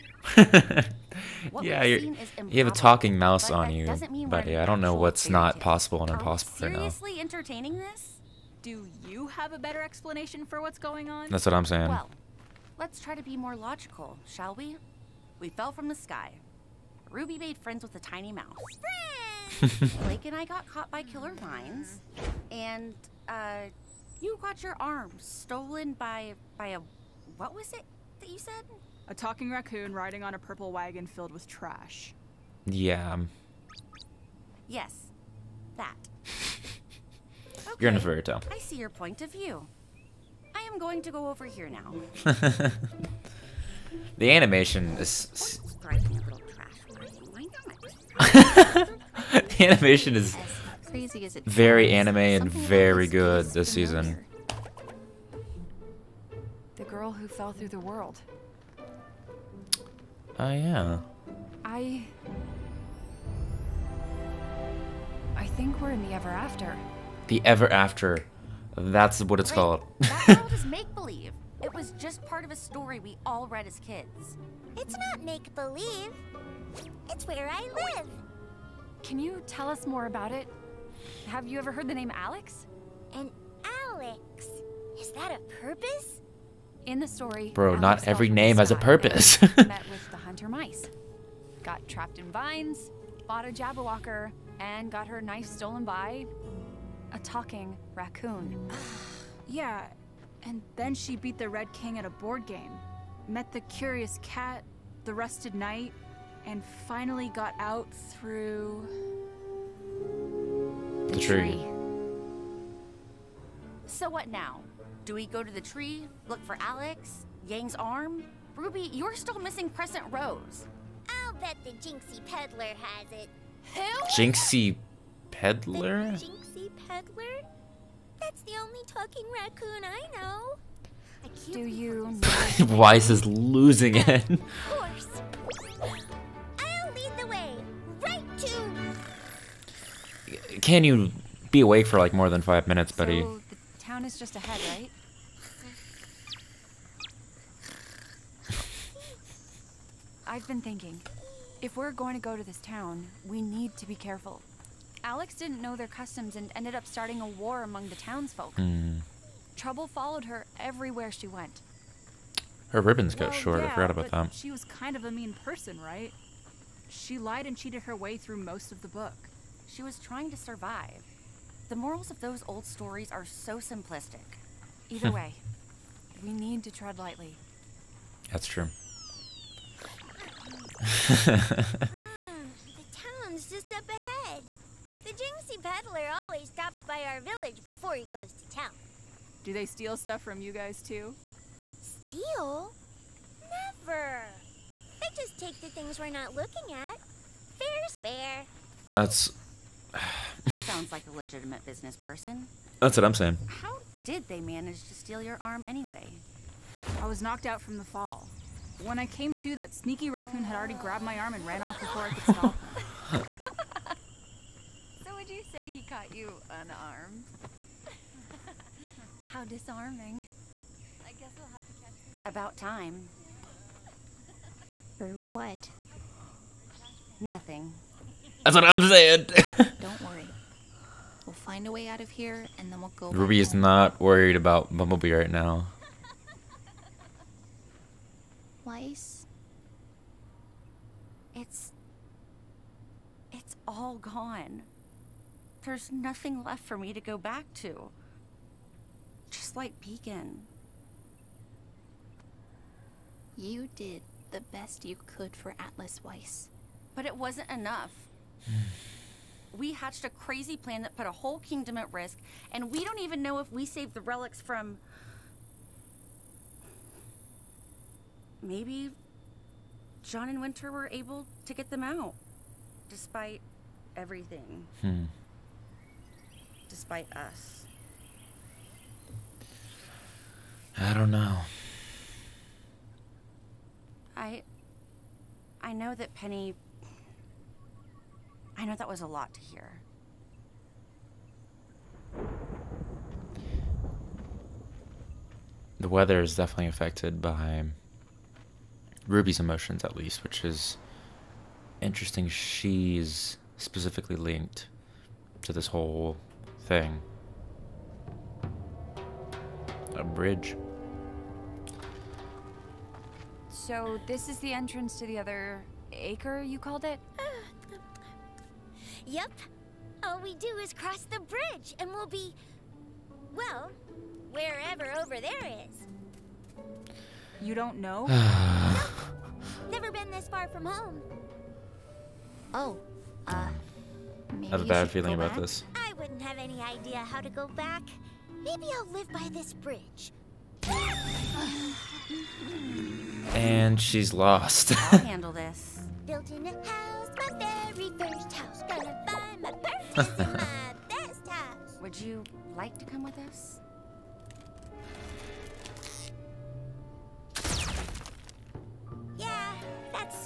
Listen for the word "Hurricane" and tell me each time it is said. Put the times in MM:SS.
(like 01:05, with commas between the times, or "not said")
not said.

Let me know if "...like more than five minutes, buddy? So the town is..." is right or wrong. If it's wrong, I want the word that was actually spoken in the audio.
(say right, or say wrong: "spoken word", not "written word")
right.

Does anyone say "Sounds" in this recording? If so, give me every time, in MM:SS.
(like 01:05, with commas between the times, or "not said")
03:20.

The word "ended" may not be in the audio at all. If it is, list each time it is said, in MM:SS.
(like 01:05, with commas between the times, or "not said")
02:36.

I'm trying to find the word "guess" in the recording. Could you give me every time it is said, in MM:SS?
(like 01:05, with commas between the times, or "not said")
03:41.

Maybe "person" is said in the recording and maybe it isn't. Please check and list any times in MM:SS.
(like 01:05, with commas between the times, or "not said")
02:45, 03:21.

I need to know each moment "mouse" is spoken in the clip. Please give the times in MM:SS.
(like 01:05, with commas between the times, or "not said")
00:03, 00:18.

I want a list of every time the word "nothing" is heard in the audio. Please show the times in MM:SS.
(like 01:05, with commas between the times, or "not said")
03:47, 04:05.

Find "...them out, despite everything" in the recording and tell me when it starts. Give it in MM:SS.
04:31.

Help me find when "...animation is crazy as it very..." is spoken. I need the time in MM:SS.
00:49.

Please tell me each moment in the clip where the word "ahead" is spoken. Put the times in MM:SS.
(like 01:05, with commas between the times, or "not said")
02:24, 03:03.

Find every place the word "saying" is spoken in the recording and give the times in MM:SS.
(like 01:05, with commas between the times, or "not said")
00:11, 03:23, 03:48.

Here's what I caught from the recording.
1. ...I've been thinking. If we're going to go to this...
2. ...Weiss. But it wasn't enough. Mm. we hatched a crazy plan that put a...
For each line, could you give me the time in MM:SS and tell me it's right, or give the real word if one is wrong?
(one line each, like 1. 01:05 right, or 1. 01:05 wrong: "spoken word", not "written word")
1. 02:30 right
2. 04:16 right.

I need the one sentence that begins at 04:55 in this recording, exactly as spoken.
The weather is definitely affected by Ruby's emotions, at least, which is interesting.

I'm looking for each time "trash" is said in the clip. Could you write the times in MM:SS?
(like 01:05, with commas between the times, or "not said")
00:31.